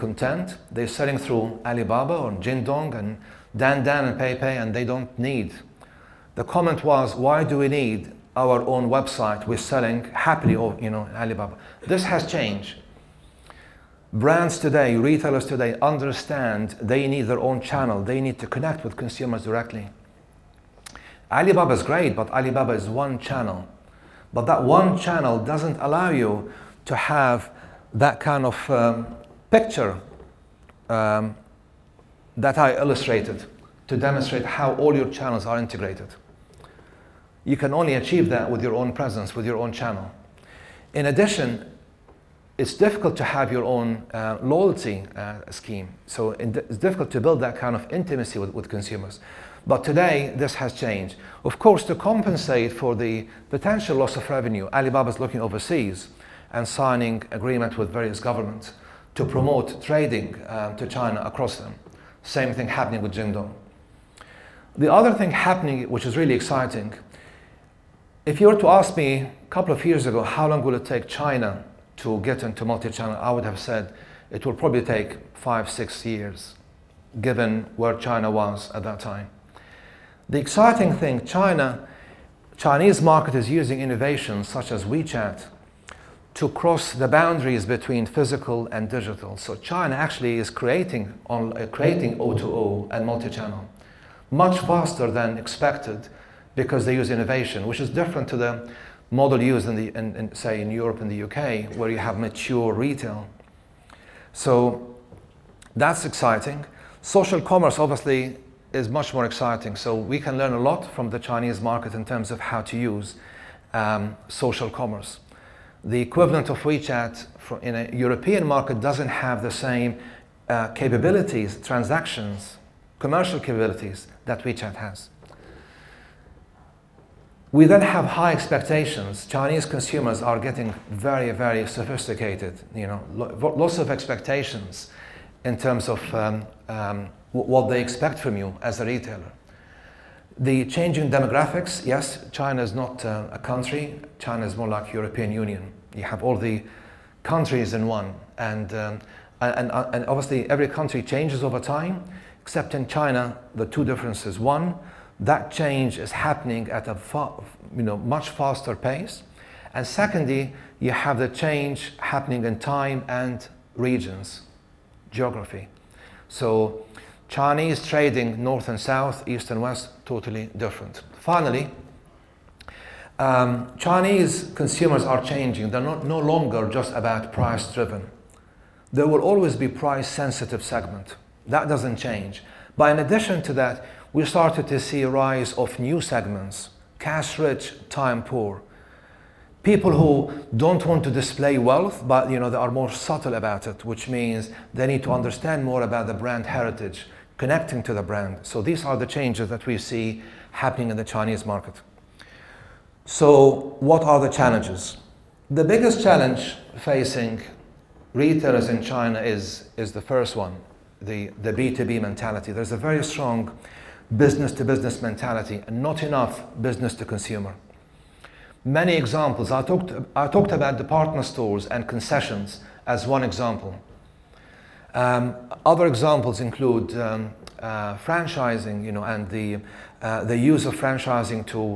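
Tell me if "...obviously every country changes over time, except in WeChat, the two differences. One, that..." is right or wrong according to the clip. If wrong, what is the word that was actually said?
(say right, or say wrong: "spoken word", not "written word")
wrong: "China", not "WeChat".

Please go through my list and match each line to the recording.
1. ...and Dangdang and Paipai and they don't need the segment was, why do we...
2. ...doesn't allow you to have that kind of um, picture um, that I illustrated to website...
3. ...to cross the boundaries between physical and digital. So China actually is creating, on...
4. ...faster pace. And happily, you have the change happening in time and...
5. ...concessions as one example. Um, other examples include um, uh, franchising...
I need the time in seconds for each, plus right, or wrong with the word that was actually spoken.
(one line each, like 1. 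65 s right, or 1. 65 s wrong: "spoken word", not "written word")
1. 2 s wrong: "comment", not "segment"
2. 25 s wrong: "demonstrate", not "website"
3. 86 s right
4. 158 s wrong: "secondly", not "happily"
5. 221 s right.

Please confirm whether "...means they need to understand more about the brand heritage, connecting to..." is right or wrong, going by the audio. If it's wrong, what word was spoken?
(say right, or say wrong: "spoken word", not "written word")
right.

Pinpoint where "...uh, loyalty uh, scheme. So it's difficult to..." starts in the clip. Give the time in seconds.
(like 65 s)
44 s.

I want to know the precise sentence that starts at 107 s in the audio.
Social commerce, obviously, is much more exciting.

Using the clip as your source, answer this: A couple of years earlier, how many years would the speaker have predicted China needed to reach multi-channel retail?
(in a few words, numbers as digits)
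5 or 6 years.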